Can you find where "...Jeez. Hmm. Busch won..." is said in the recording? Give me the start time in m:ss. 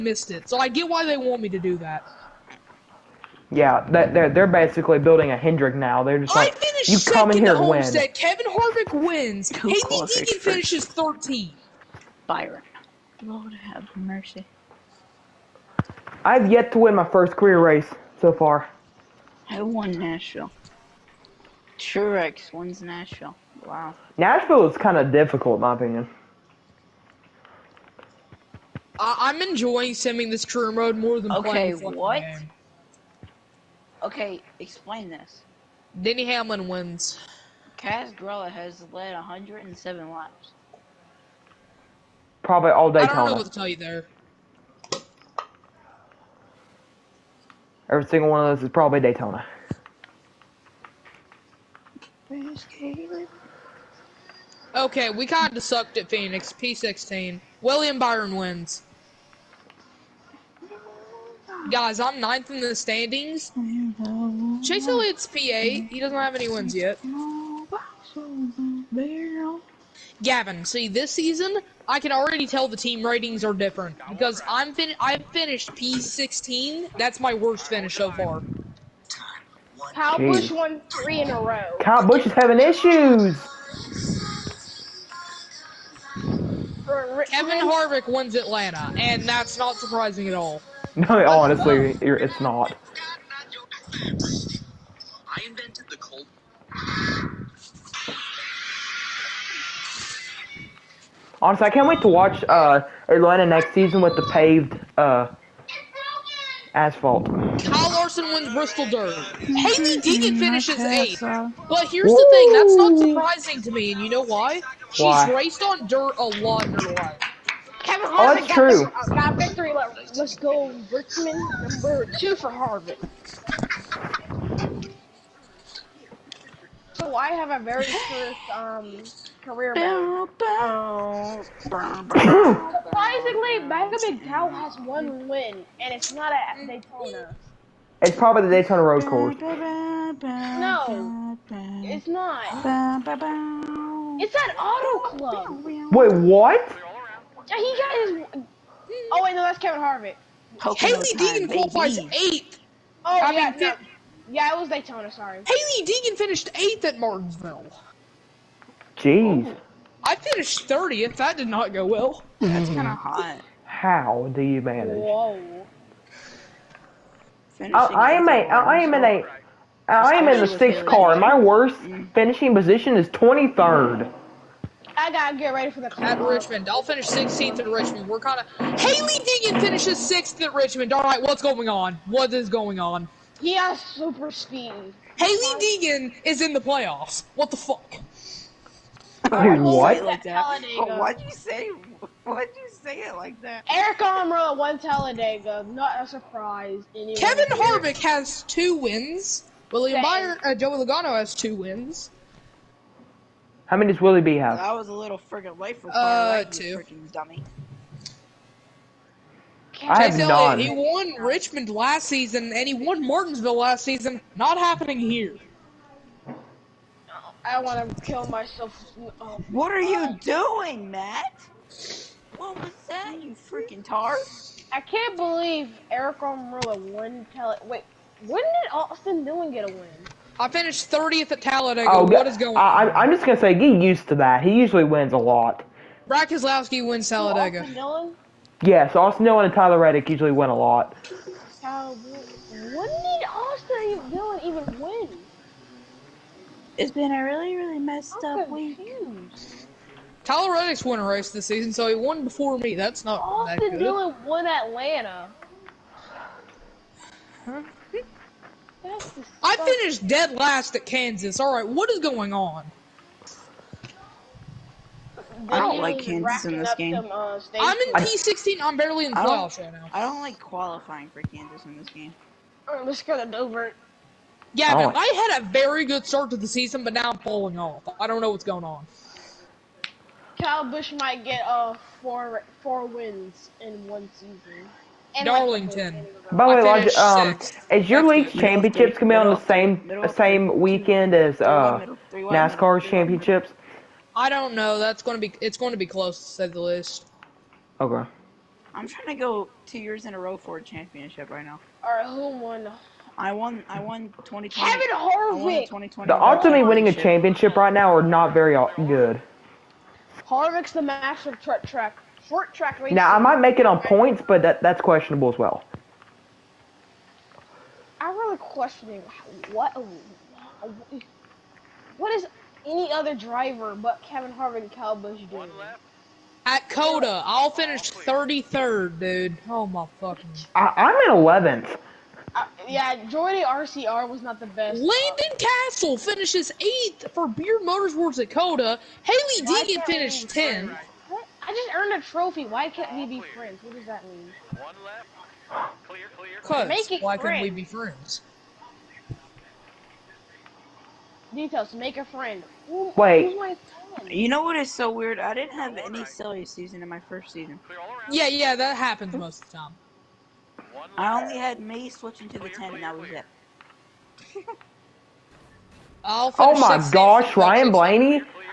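1:20.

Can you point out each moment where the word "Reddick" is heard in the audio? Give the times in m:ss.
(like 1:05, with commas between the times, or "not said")
3:59, 4:10.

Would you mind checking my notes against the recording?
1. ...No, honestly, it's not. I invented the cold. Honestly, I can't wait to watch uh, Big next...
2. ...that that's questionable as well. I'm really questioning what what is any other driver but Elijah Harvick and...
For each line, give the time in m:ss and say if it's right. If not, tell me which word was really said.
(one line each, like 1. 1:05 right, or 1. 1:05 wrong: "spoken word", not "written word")
1. 1:31 wrong: "Atlanta", not "Big"
2. 5:14 wrong: "Kevin", not "Elijah".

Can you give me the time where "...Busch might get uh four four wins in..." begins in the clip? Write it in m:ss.
4:40.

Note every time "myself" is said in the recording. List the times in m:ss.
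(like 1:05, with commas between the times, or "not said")
3:38.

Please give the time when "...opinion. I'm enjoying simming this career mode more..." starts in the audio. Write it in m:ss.
0:25.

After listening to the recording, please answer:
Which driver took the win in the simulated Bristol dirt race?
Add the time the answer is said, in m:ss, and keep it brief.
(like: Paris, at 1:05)
Kyle Larson, at 1:47.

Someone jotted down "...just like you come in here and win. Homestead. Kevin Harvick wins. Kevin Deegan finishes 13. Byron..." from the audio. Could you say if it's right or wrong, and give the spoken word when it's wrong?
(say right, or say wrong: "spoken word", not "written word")
right.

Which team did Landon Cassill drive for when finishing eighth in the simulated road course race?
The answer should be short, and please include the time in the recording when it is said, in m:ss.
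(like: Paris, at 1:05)
Beard Motorsports, at 5:37.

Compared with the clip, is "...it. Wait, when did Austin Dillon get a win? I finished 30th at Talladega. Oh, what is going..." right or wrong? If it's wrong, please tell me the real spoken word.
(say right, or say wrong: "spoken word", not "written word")
right.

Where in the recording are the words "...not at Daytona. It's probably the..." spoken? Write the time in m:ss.
2:16.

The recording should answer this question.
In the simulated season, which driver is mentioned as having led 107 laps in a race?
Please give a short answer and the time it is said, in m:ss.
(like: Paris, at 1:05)
Kaz Grala, at 0:37.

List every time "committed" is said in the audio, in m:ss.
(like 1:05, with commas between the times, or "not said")
not said.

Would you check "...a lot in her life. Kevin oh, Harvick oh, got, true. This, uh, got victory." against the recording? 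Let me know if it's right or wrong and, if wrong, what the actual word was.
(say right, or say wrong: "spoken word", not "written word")
right.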